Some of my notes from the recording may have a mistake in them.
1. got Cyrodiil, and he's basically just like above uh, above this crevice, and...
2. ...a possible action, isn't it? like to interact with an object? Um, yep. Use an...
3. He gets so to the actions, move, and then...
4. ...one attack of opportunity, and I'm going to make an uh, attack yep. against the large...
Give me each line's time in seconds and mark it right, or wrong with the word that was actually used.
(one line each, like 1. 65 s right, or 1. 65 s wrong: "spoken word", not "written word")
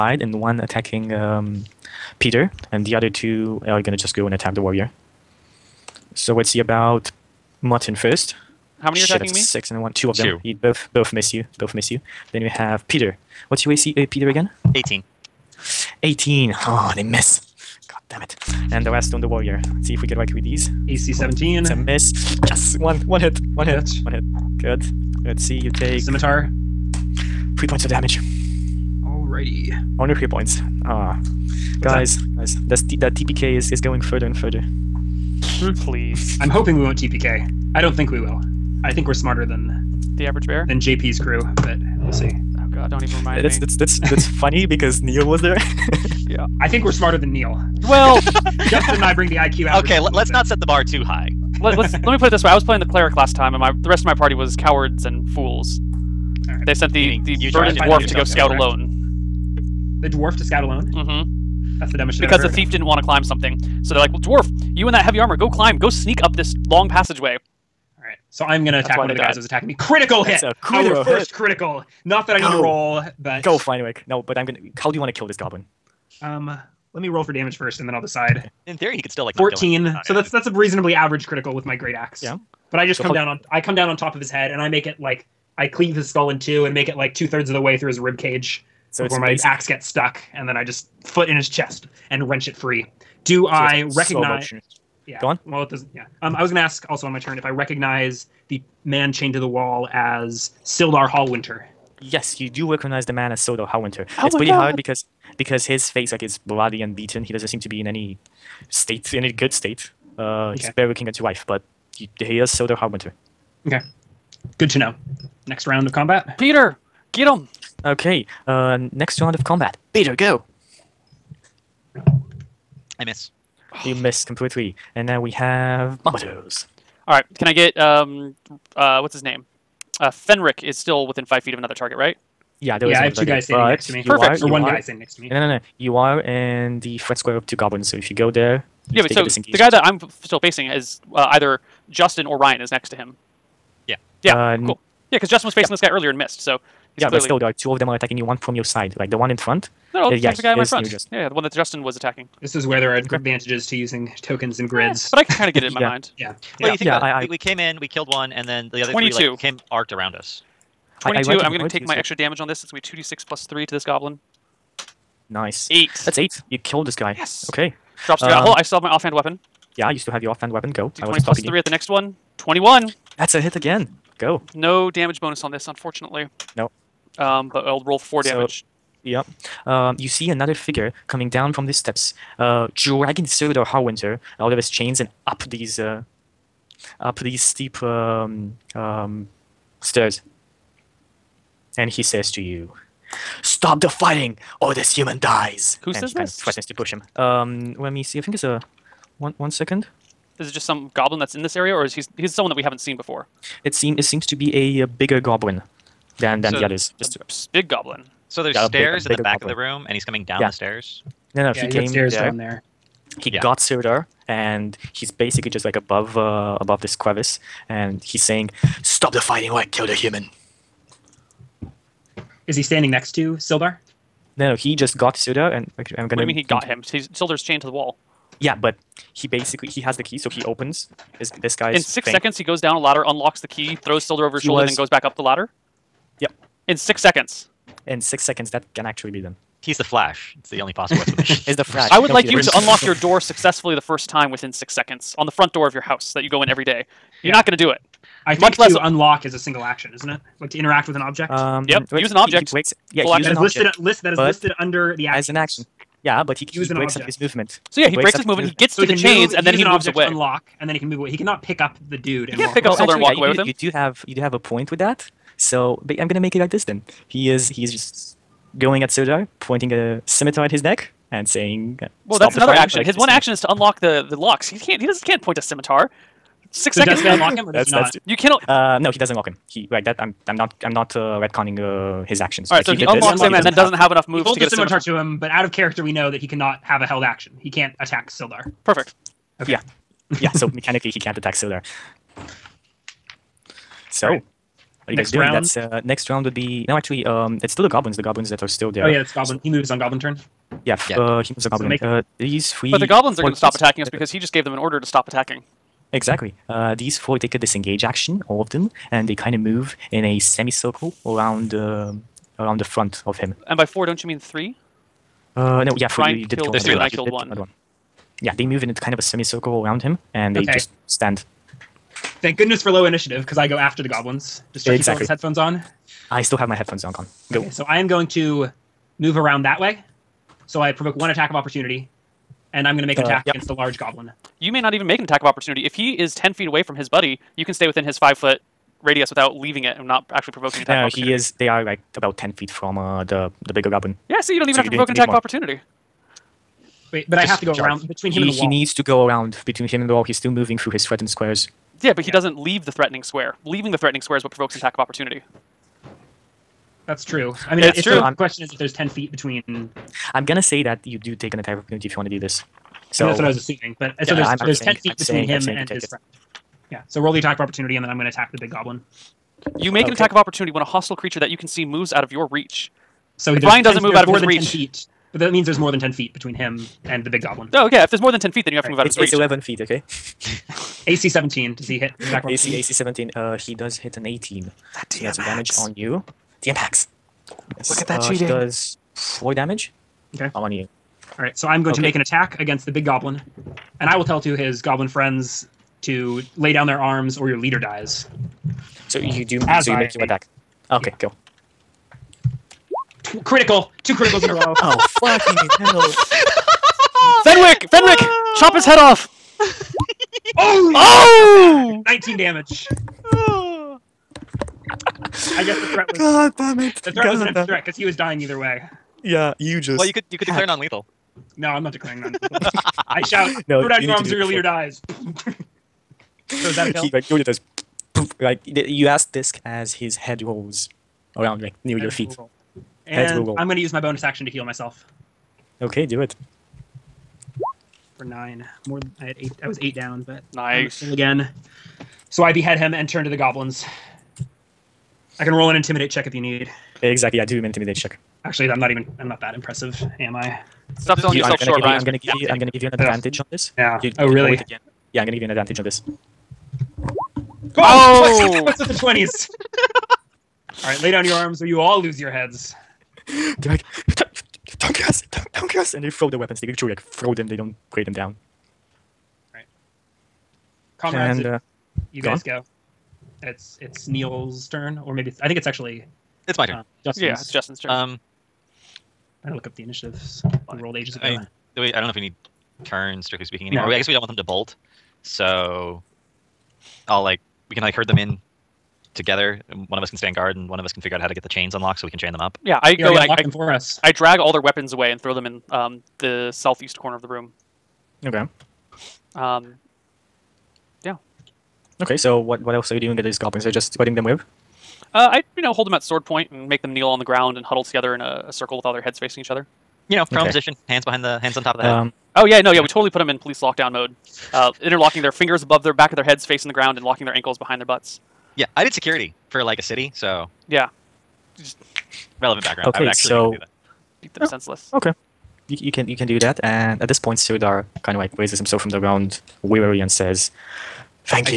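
1. 213 s right
2. 249 s wrong: "single", not "possible"
3. 258 s wrong: "chains", not "actions"
4. 330 s right.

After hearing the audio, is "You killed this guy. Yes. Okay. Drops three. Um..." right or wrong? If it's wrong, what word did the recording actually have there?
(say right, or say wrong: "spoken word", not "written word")
right.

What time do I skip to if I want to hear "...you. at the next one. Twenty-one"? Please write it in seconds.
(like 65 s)
171 s.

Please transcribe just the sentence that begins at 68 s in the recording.
So I'm gonna attack one of the died.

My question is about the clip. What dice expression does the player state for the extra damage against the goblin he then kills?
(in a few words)
2d6 plus 3.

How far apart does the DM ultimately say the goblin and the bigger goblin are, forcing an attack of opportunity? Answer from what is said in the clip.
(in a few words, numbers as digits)
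11 feet.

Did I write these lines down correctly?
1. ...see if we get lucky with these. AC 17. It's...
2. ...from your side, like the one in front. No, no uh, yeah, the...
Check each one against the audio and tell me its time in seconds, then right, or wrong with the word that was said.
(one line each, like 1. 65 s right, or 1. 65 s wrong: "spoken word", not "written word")
1. 19 s right
2. 148 s right.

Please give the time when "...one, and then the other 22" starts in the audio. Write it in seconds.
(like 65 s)
158 s.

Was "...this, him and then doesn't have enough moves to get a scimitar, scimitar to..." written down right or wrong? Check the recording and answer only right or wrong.
right.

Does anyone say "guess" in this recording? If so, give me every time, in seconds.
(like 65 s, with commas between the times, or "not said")
415 s, 483 s.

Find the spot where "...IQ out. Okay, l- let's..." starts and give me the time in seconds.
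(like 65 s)
49 s.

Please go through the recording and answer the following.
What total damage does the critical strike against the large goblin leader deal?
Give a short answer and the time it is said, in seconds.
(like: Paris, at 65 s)
19, at 411 s.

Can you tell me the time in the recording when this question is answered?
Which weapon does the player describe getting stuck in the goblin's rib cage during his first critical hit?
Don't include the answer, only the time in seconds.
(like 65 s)
81 s.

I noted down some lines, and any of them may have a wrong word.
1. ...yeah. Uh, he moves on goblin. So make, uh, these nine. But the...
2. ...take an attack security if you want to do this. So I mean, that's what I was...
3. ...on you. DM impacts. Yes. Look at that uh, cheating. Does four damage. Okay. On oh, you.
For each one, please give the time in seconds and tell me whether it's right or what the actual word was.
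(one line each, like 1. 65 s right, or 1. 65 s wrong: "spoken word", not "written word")
1. 300 s wrong: "three", not "nine"
2. 361 s wrong: "opportunity", not "security"
3. 385 s right.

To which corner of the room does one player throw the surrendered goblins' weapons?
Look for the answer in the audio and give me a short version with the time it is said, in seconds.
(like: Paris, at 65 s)
southeast corner, at 496 s.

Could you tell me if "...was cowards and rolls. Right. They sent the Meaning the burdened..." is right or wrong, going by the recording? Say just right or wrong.
wrong.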